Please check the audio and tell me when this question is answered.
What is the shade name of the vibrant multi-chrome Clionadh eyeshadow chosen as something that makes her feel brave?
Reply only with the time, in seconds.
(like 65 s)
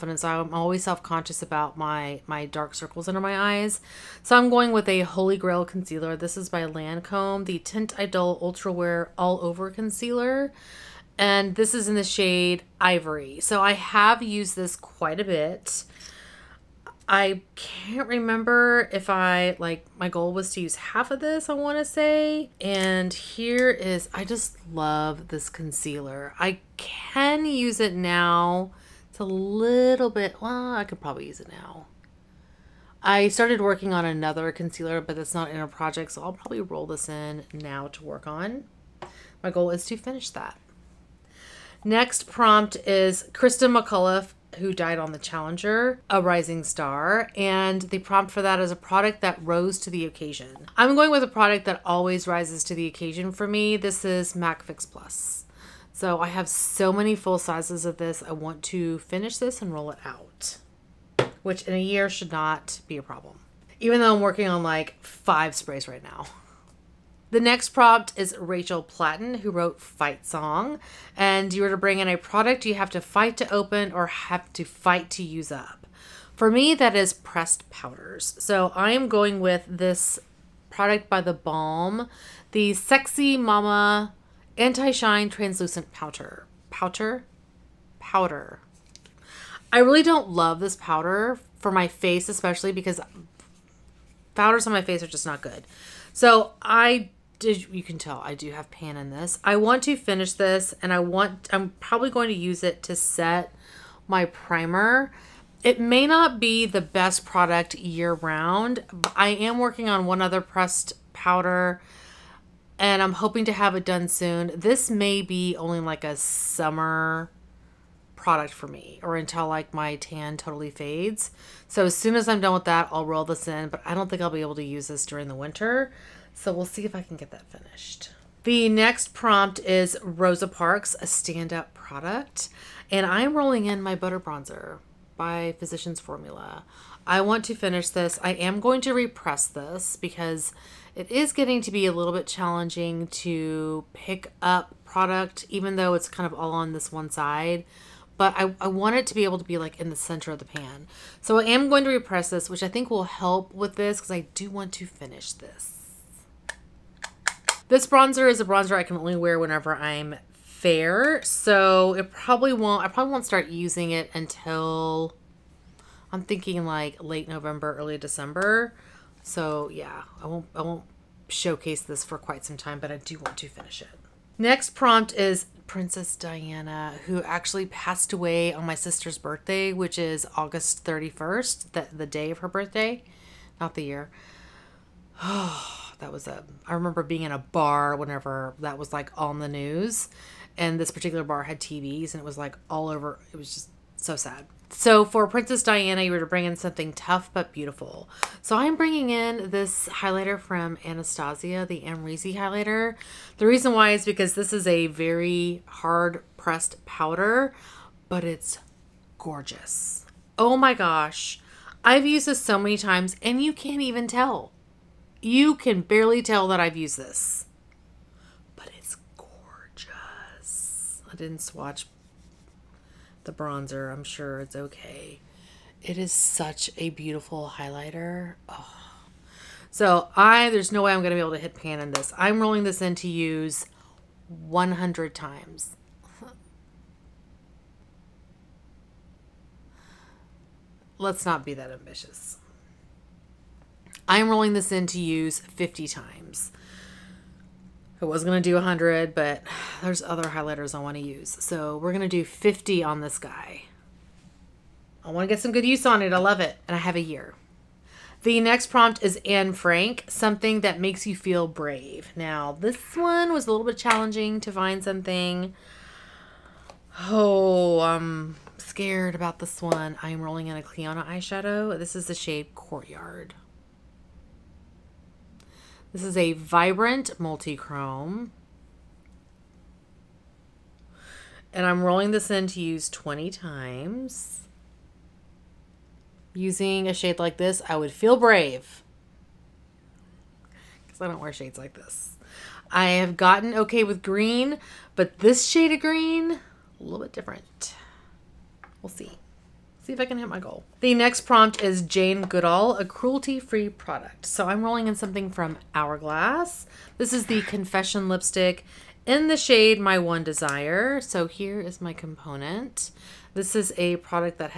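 272 s.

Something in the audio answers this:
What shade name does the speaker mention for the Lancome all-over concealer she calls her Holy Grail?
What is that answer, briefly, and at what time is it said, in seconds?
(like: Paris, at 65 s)
Ivory, at 12 s.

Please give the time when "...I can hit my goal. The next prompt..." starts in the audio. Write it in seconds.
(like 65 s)
299 s.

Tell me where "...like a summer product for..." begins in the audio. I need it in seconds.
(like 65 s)
115 s.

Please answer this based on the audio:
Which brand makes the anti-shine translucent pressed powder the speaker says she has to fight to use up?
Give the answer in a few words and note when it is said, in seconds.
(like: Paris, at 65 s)
The Balm, at 81 s.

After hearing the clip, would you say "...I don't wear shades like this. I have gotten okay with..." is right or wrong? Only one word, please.
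right.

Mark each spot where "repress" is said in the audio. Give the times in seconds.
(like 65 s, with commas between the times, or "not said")
138 s, 151 s.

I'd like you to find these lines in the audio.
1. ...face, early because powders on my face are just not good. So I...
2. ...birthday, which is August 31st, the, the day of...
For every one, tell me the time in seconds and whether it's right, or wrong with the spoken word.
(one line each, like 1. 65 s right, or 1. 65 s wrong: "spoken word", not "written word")
1. 91 s wrong: "especially", not "early"
2. 179 s right.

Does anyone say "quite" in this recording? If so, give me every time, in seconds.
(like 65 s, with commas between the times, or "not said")
14 s, 172 s.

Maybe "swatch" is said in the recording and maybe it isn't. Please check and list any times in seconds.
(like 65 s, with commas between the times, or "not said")
221 s.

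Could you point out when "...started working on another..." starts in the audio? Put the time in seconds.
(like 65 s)
33 s.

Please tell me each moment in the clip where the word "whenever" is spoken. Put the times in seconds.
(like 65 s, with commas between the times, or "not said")
159 s, 187 s.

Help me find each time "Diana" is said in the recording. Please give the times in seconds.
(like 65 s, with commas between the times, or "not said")
176 s, 195 s.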